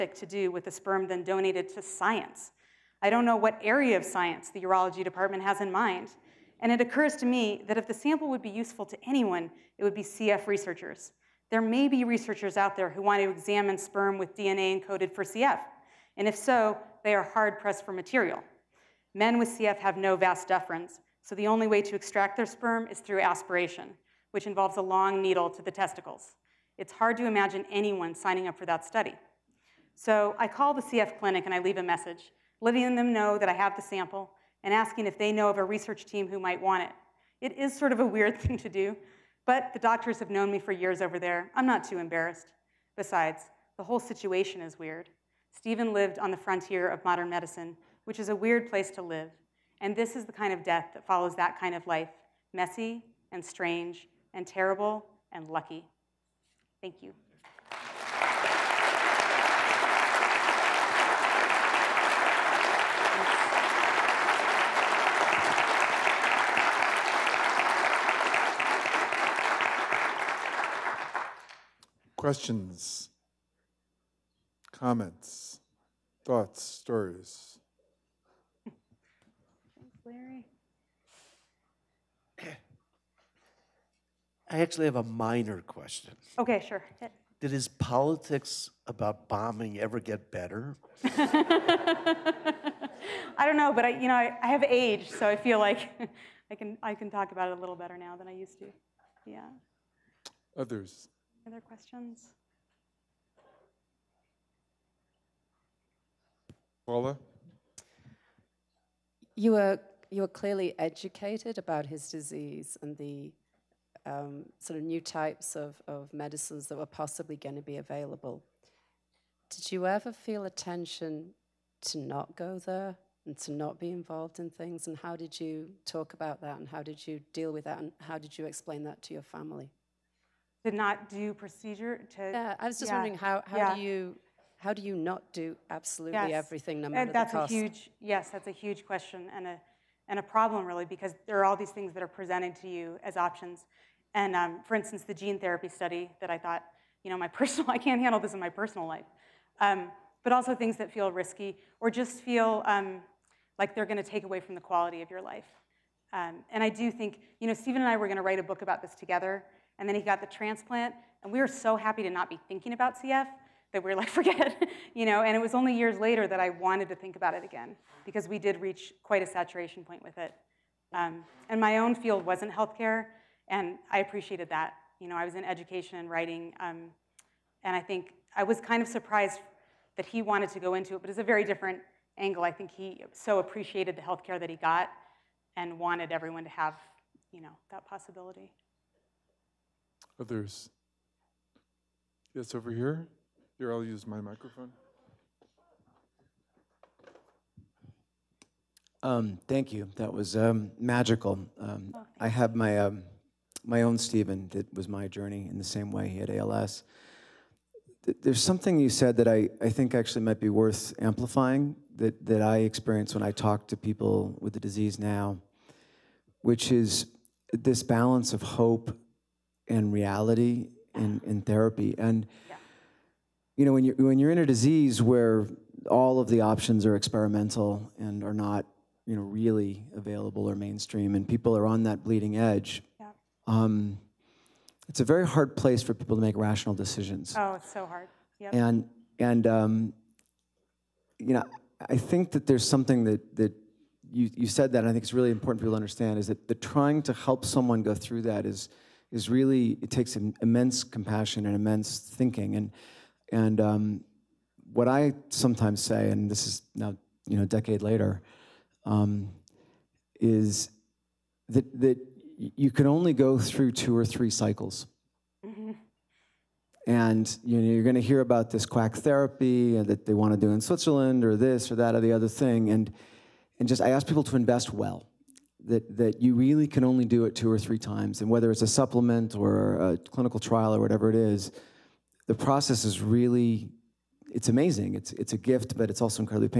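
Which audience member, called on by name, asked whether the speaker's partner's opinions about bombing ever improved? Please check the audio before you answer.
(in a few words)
Larry.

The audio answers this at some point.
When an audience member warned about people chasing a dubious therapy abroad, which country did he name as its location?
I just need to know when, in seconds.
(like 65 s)
270 s.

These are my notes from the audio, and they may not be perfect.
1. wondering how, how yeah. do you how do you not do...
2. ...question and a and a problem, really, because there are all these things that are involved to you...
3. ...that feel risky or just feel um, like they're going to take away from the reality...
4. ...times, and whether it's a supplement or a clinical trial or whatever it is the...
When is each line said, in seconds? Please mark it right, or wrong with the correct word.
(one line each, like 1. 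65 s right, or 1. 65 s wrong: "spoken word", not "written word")
1. 132 s right
2. 138 s wrong: "presented", not "involved"
3. 150 s wrong: "quality", not "reality"
4. 277 s right.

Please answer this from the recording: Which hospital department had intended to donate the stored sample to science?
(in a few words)
The urology department.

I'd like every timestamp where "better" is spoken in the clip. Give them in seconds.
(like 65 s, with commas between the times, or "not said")
90 s, 97 s.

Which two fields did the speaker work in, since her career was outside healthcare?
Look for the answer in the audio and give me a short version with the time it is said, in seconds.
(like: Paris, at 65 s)
Education and writing, at 175 s.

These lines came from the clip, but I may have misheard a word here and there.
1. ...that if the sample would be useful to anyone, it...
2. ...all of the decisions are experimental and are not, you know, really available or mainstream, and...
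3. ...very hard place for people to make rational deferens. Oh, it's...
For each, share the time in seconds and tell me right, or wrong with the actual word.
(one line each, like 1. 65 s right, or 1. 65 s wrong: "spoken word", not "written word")
1. 7 s right
2. 225 s wrong: "options", not "decisions"
3. 235 s wrong: "decisions", not "deferens".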